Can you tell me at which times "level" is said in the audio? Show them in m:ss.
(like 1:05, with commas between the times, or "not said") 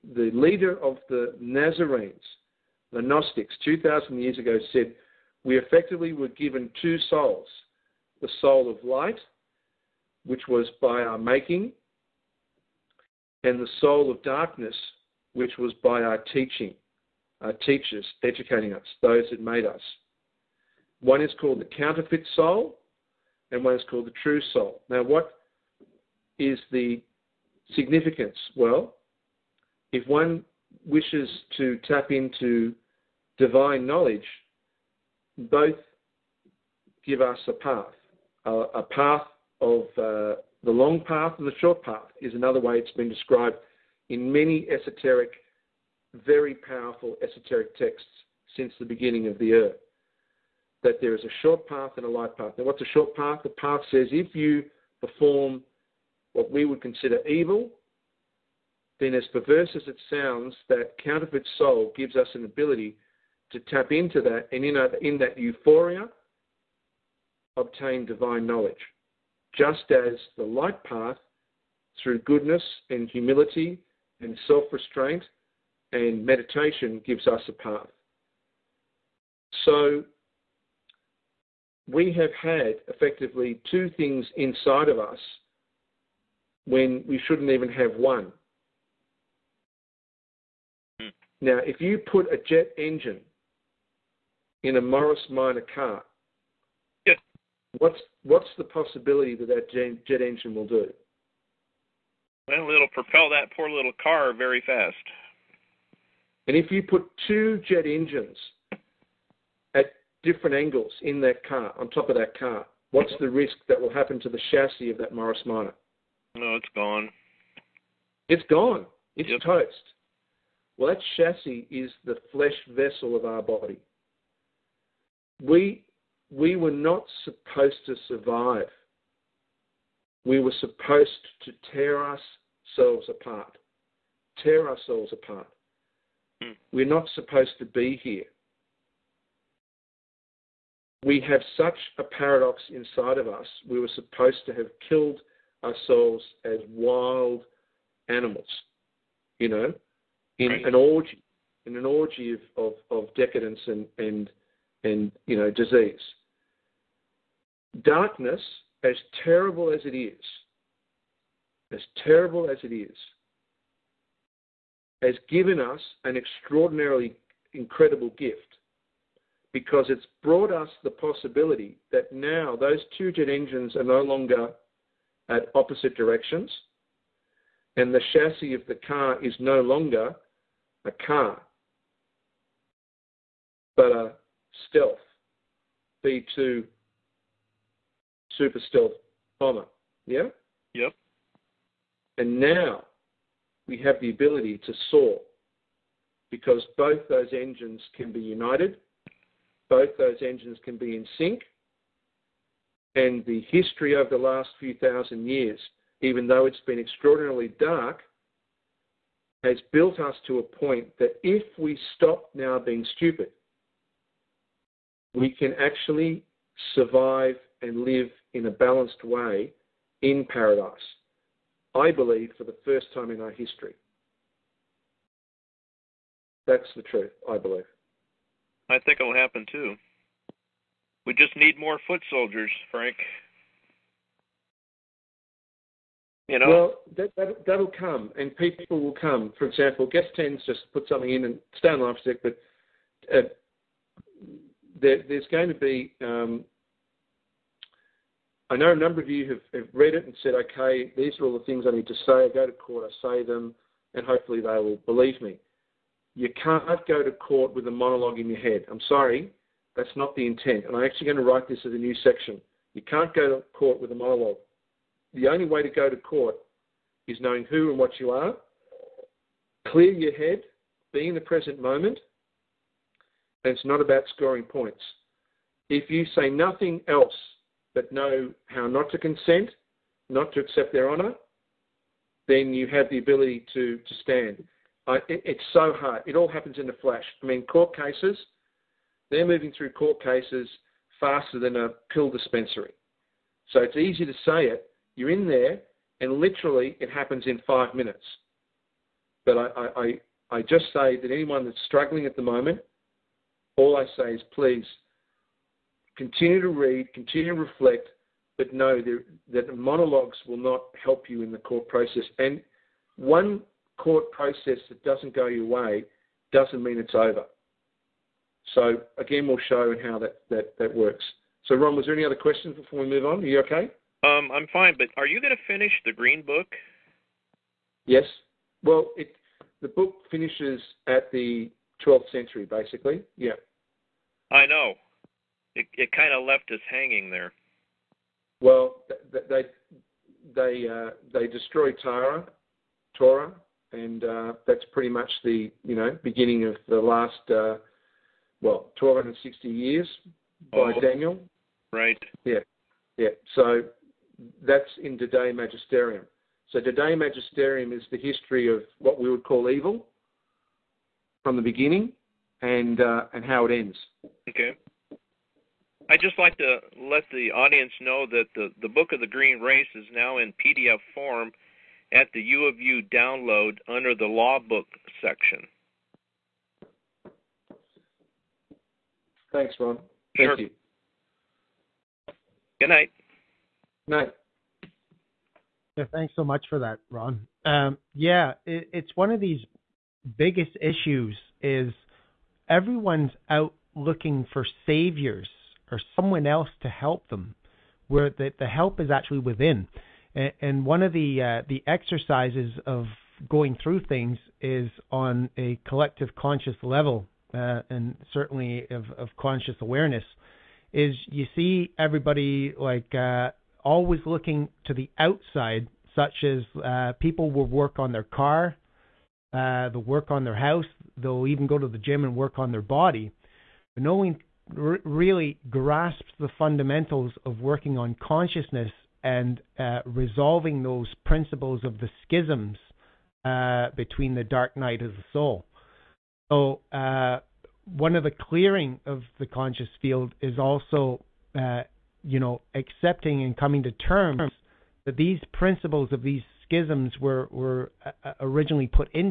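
6:46.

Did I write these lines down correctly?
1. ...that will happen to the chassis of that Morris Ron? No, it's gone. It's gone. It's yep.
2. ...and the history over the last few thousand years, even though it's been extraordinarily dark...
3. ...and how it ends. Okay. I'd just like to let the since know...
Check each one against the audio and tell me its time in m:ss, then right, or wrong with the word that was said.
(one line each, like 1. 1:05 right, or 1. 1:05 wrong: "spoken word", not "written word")
1. 1:53 wrong: "Minor", not "Ron"
2. 3:22 right
3. 6:03 wrong: "audience", not "since".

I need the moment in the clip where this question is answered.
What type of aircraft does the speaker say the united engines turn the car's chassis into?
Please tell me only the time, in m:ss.
3:04.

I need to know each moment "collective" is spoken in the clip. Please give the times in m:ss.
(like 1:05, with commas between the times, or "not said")
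6:45.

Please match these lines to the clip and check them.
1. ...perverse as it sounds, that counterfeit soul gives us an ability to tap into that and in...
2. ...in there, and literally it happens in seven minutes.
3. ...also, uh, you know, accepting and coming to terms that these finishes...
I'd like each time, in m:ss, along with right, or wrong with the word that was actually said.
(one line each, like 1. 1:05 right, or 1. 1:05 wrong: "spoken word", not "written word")
1. 0:59 right
2. 4:55 wrong: "five", not "seven"
3. 7:20 wrong: "principles", not "finishes".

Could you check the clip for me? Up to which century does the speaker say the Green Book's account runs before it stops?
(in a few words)
12th century.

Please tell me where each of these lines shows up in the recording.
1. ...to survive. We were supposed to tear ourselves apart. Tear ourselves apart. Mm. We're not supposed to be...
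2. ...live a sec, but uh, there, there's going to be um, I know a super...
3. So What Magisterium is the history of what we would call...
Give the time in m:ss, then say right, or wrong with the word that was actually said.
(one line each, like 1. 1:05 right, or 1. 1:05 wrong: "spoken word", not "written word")
1. 2:07 right
2. 4:01 wrong: "number", not "super"
3. 5:56 wrong: "Today", not "What".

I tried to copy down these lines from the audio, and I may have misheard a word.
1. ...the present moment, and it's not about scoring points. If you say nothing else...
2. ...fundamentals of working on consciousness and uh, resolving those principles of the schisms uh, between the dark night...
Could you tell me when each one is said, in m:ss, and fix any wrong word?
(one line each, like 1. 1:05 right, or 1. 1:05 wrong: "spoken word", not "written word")
1. 4:31 right
2. 7:06 right.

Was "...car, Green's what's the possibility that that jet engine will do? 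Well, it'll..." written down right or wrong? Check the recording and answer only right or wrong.
wrong.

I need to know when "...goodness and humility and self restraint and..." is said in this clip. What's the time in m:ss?
1:12.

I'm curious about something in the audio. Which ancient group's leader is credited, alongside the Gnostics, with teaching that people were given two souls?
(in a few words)
the Nazarenes.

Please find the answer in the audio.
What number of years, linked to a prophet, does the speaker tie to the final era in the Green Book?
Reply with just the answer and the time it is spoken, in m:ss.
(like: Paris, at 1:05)
1260, at 5:48.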